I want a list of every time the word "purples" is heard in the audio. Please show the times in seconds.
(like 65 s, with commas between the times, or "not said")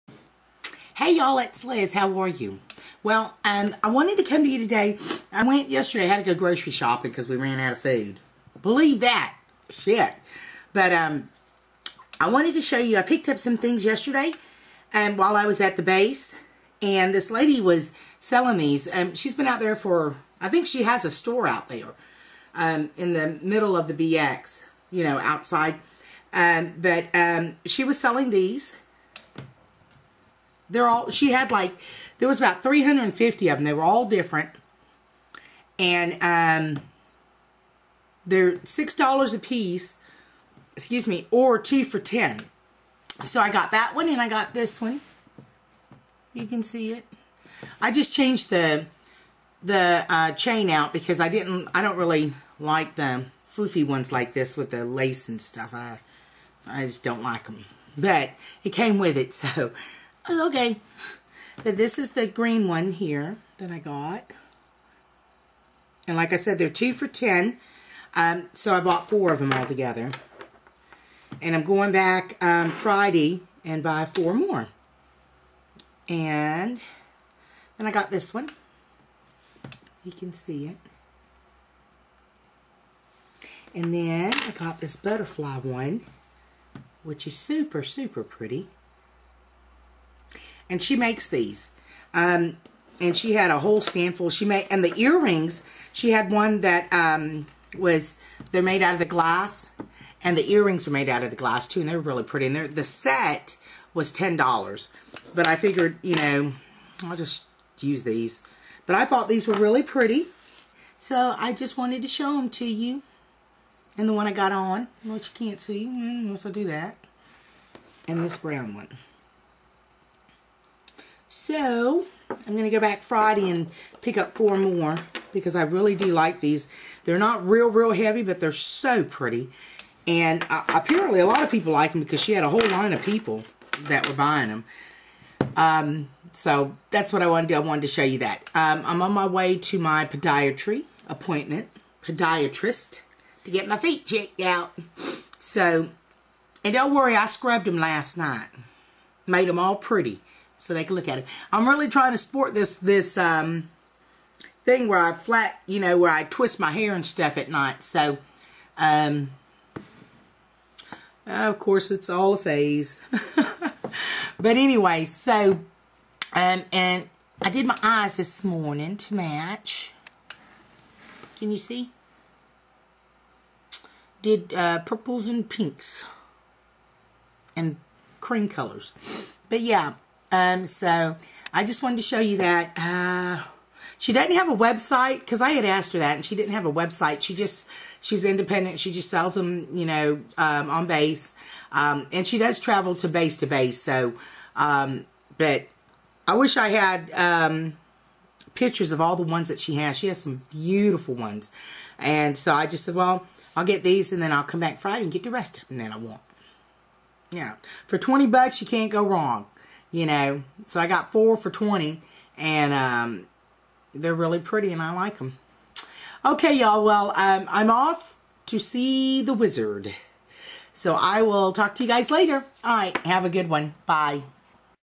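174 s.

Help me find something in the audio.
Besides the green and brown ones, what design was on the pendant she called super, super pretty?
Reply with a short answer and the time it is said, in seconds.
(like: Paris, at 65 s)
Butterfly, at 84 s.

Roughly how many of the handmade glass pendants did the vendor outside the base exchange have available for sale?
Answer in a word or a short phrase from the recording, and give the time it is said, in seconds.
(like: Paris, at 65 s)
350, at 32 s.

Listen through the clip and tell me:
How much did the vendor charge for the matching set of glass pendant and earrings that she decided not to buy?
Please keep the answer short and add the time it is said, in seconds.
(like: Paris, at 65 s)
$10, at 104 s.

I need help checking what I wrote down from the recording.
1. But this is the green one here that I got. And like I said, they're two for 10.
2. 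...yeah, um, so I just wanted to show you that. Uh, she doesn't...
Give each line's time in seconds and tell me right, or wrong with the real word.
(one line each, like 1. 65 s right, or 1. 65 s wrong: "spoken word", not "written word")
1. 61 s right
2. 179 s right.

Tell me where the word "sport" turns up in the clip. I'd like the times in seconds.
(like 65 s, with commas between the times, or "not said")
152 s.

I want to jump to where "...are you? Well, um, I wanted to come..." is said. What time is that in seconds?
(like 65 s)
2 s.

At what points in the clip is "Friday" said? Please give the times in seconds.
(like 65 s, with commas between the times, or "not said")
72 s, 123 s, 204 s.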